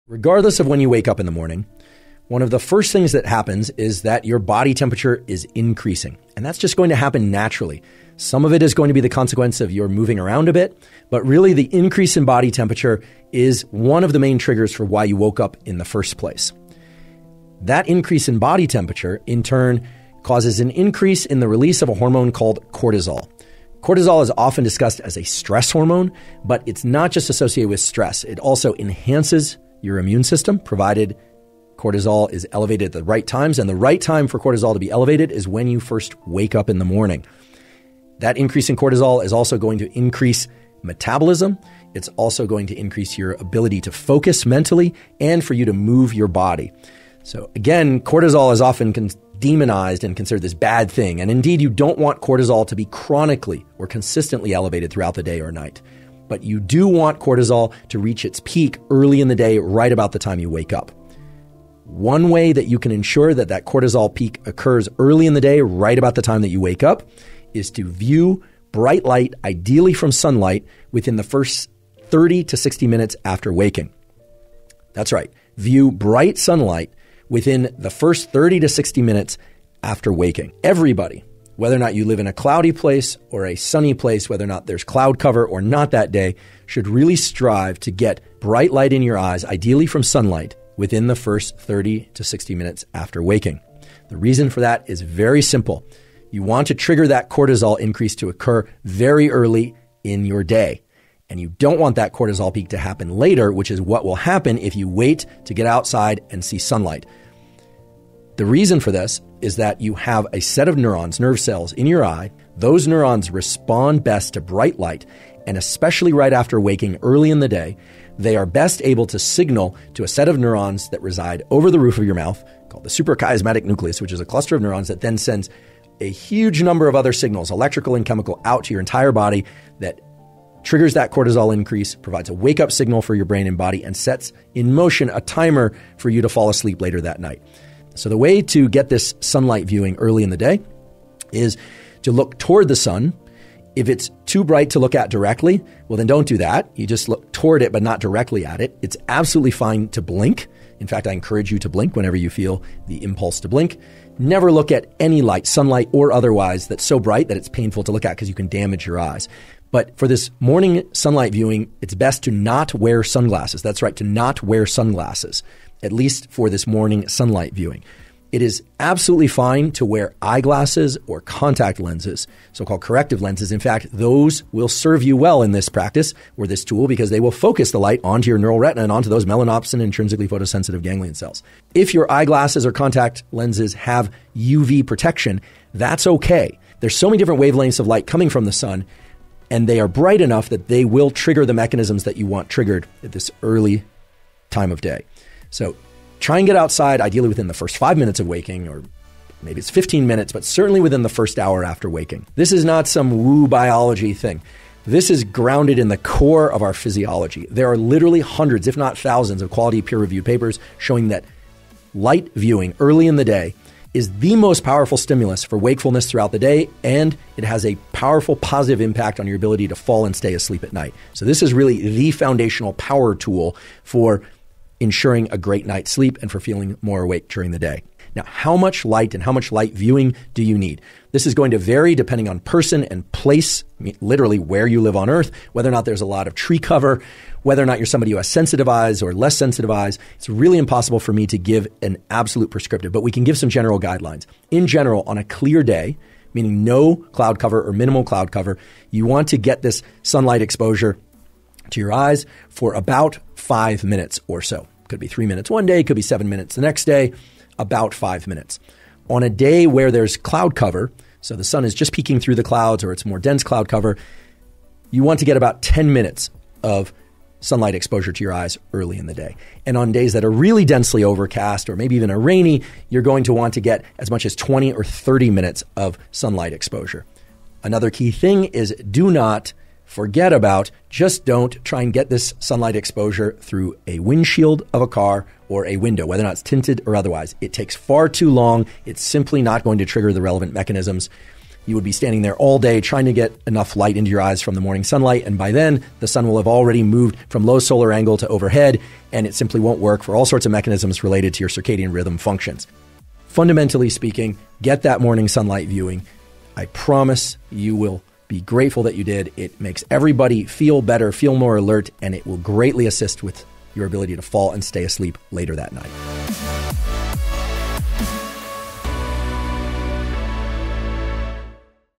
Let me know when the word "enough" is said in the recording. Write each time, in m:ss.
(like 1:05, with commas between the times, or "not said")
3:10, 4:53.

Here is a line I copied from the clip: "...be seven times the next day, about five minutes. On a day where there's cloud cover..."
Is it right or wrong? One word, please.
wrong.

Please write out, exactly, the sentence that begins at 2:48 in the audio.
It is absolutely fine to wear eyeglasses or contact lenses, so called corrective lenses.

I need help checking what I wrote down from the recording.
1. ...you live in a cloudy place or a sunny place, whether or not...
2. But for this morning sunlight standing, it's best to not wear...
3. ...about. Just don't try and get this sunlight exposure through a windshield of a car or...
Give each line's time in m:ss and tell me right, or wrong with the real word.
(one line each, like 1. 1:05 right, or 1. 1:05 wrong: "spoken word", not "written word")
1. 1:21 right
2. 2:39 wrong: "viewing", not "standing"
3. 4:40 right.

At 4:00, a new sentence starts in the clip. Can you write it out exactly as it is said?
It's really impossible for me to give an absolute prescriptive, but we can give some general guidelines.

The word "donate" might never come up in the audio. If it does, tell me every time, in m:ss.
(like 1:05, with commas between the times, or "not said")
not said.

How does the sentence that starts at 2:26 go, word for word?
You just look toward it, but not directly at it.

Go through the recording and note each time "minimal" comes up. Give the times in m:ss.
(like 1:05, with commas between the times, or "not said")
4:07.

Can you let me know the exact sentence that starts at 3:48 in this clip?
Now, how much light and how much light viewing do you need?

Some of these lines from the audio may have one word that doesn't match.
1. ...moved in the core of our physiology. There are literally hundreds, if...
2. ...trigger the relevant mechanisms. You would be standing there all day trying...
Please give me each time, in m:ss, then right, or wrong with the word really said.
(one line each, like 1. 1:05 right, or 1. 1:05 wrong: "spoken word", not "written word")
1. 3:25 wrong: "grounded", not "moved"
2. 4:49 right.